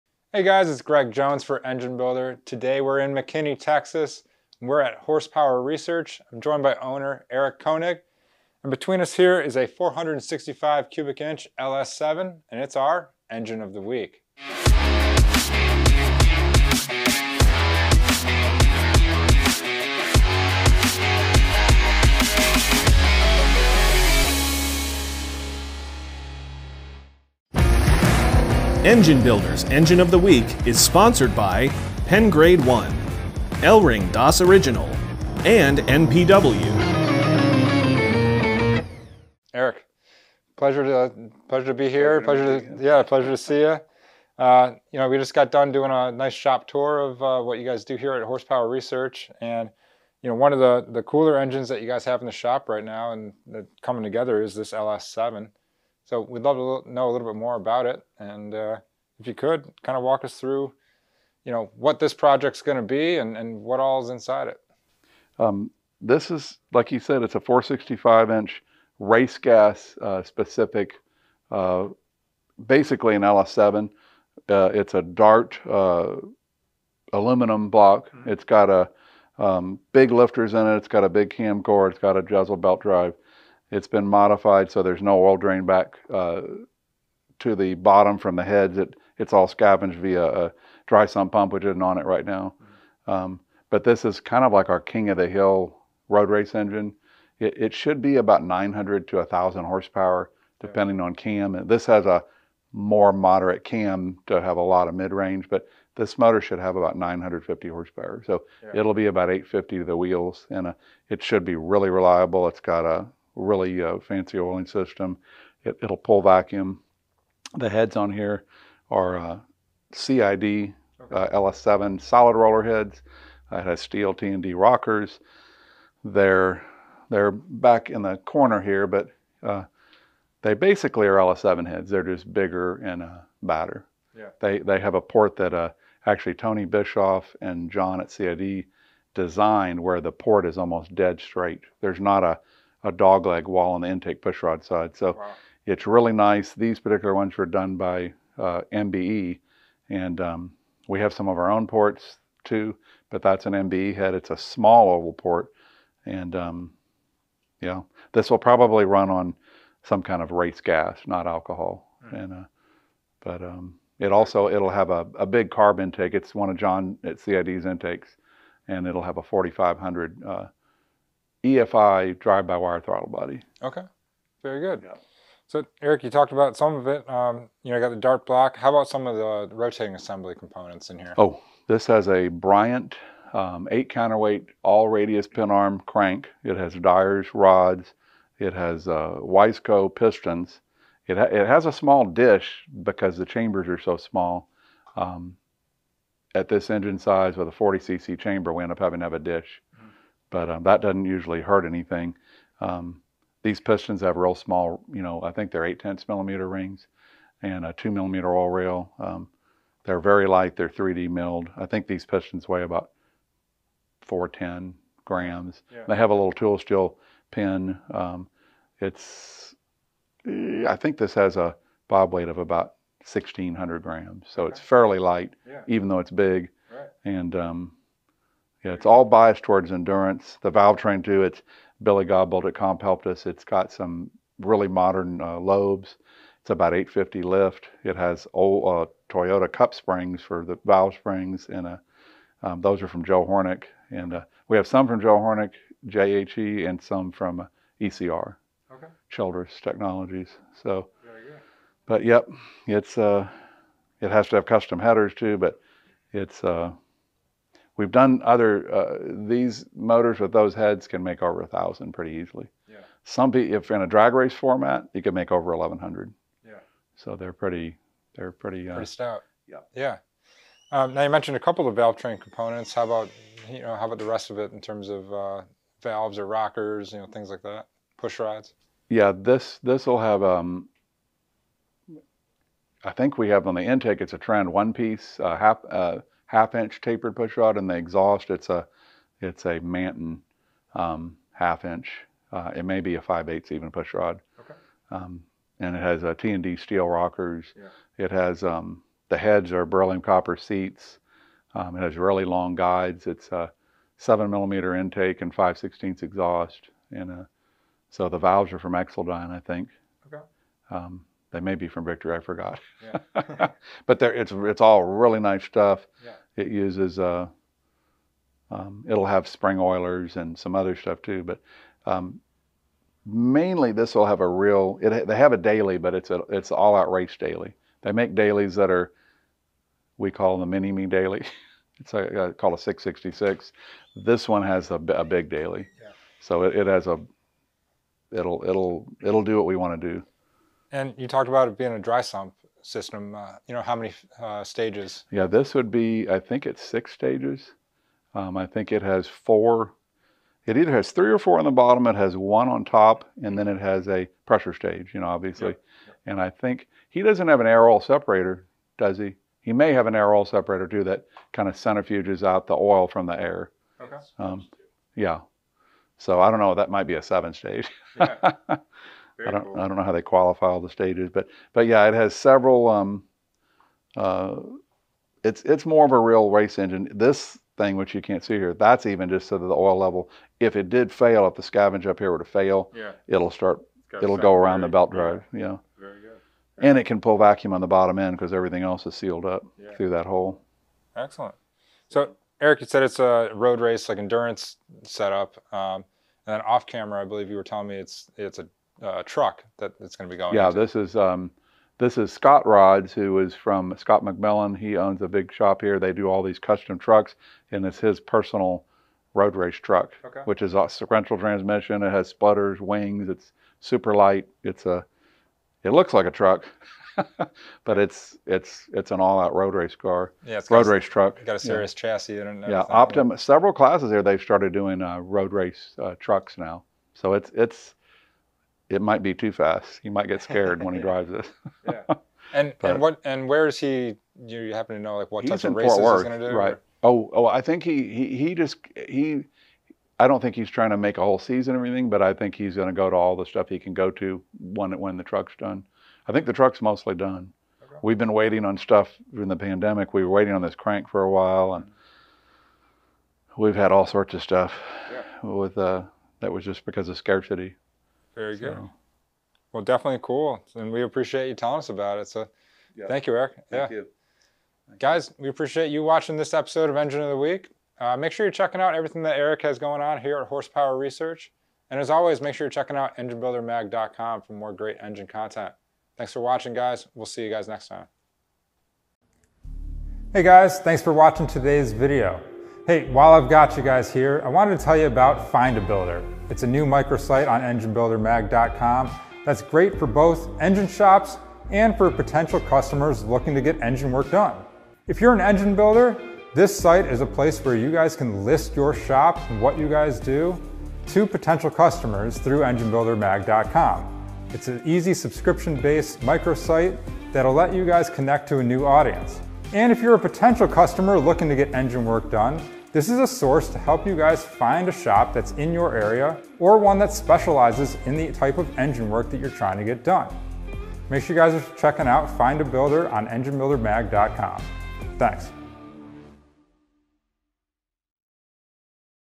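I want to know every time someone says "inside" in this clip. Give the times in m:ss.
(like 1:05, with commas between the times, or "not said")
1:04.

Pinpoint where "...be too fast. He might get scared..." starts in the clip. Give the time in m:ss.
7:09.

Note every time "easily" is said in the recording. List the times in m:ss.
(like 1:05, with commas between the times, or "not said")
4:22.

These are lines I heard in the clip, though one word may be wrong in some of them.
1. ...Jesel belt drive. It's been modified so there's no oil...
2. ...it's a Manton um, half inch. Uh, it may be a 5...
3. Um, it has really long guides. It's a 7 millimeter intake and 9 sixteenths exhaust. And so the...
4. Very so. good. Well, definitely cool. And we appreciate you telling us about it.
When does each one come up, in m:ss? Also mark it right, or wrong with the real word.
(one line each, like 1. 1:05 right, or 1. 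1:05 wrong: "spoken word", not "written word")
1. 1:22 right
2. 4:49 right
3. 5:01 wrong: "5", not "9"
4. 7:38 right.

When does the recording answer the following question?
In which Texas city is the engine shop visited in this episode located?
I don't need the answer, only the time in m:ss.
0:03.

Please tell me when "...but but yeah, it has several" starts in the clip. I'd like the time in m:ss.
6:11.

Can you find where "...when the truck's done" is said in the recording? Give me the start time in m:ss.
7:24.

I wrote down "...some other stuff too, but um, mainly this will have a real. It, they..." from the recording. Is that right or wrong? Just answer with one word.
right.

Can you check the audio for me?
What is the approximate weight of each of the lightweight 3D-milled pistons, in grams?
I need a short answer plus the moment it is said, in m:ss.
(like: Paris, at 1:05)
410 grams, at 3:34.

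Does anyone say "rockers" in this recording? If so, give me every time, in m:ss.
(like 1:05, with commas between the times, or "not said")
2:04, 4:36, 4:56.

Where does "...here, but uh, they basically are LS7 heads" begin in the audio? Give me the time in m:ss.
2:08.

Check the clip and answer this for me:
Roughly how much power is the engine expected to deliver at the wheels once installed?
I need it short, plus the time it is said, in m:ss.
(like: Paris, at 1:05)
850, at 1:49.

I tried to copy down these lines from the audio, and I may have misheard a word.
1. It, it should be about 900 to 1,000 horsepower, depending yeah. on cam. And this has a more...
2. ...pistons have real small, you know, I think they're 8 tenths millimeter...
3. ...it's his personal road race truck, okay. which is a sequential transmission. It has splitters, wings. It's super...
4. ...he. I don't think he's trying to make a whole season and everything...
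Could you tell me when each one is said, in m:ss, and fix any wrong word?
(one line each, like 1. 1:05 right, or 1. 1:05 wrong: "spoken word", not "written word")
1. 1:37 right
2. 3:23 right
3. 6:47 right
4. 7:18 right.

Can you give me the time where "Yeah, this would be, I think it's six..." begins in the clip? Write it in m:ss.
5:45.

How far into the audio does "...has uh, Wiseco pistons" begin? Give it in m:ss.
3:08.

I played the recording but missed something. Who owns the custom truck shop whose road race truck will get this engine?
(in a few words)
Scott McMillan.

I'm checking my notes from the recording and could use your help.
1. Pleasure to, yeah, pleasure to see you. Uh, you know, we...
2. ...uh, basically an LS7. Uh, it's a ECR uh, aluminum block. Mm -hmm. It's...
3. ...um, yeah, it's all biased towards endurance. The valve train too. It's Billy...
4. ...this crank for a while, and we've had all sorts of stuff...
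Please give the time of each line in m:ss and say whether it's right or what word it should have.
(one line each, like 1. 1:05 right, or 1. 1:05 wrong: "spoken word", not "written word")
1. 0:42 right
2. 1:11 wrong: "Dart", not "ECR"
3. 3:47 right
4. 7:30 right.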